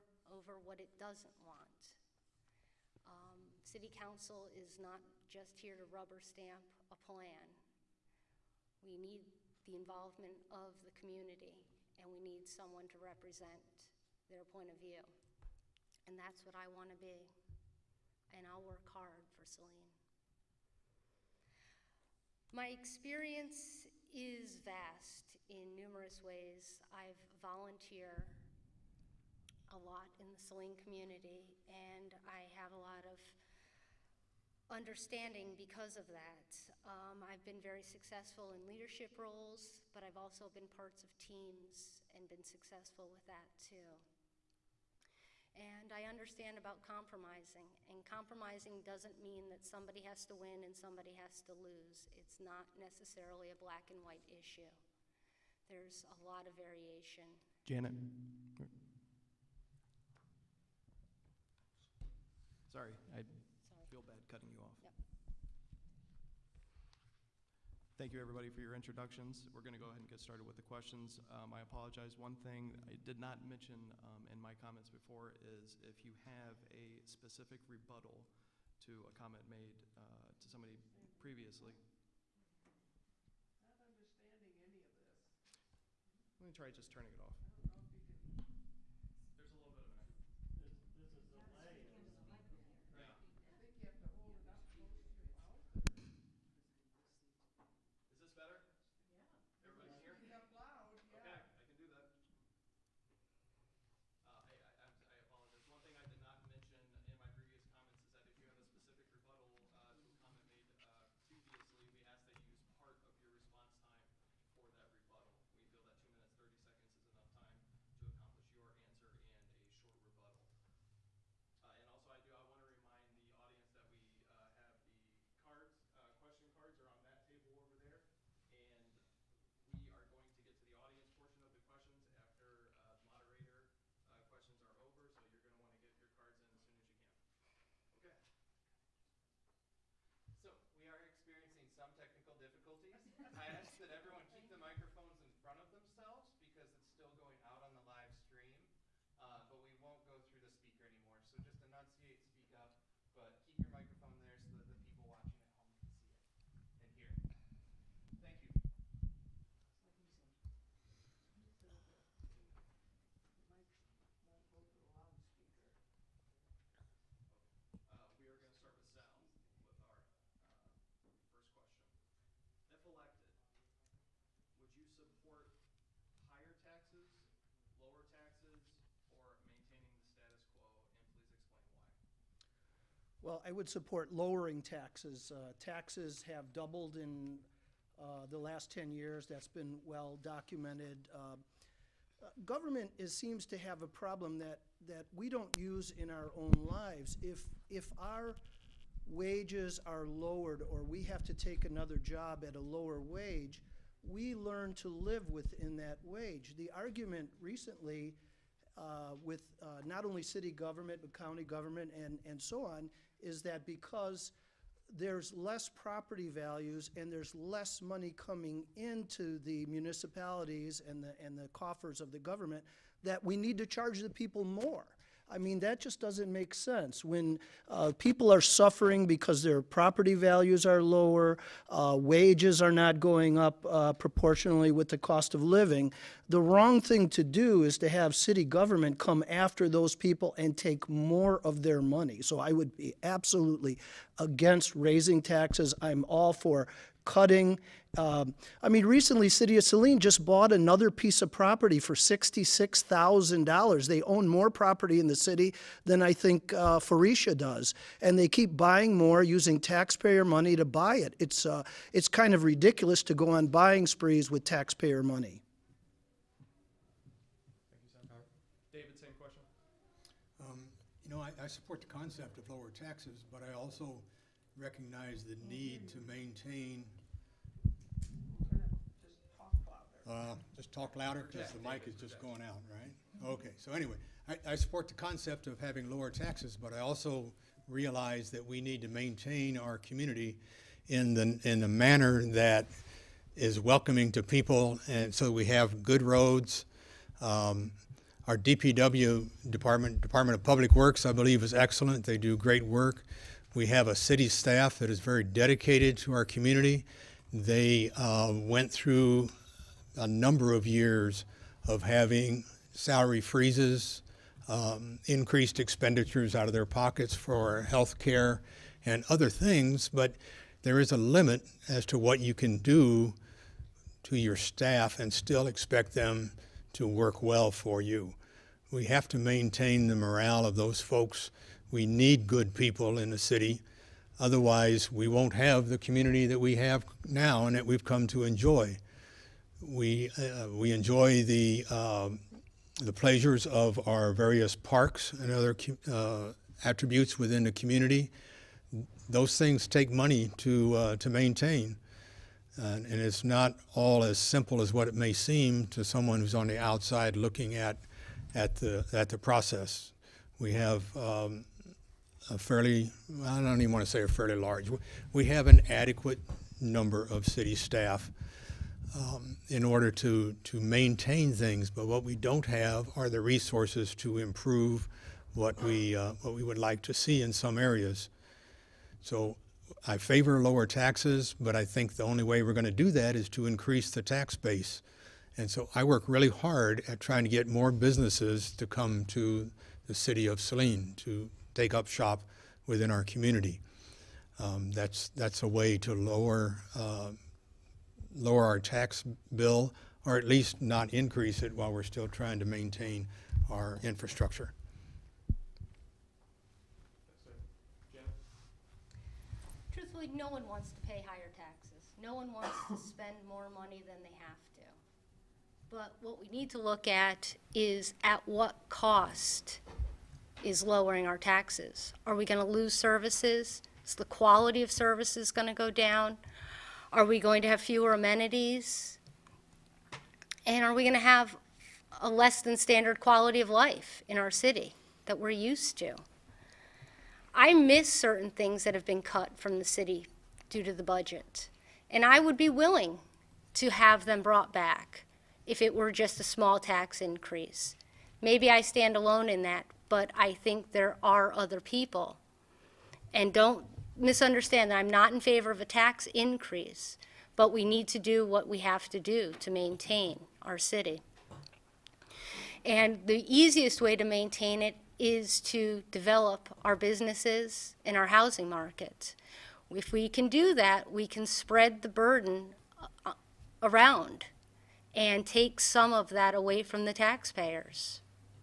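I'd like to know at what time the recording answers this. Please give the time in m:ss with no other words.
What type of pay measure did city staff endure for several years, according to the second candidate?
5:12.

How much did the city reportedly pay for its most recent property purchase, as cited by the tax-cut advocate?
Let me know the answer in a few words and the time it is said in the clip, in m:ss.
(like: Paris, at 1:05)
$66,000, at 4:11.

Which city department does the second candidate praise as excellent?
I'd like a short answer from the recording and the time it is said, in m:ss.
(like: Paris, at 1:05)
Department of Public Works, at 5:00.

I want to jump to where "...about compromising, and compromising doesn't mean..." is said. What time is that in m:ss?
0:46.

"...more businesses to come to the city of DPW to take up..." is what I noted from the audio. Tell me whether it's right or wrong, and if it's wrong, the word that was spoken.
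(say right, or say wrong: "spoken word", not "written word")
wrong: "Saline", not "DPW".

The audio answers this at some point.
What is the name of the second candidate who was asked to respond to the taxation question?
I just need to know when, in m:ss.
4:28.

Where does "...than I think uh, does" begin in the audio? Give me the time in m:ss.
4:15.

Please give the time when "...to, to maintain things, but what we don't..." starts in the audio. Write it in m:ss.
6:09.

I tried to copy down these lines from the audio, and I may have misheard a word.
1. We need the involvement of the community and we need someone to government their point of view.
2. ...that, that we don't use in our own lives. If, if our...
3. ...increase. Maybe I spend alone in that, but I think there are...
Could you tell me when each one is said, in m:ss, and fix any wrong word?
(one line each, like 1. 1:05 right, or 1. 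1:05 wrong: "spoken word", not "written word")
1. 0:08 wrong: "represent", not "government"
2. 3:14 right
3. 7:27 wrong: "stand", not "spend".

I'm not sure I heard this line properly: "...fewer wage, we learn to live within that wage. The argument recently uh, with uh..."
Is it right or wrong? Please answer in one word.
wrong.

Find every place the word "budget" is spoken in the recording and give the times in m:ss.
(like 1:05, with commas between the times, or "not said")
7:20.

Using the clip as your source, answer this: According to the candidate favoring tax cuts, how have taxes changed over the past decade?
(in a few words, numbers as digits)
doubled.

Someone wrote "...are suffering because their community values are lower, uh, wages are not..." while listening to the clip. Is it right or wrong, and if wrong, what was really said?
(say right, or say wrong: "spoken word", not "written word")
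wrong: "property", not "community".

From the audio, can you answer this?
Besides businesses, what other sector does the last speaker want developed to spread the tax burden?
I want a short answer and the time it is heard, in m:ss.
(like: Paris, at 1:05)
housing market, at 7:48.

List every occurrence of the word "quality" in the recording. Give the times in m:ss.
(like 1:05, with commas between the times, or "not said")
7:04, 7:12.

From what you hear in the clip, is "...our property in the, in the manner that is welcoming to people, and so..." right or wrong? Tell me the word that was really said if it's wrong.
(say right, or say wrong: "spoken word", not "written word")
wrong: "community", not "property".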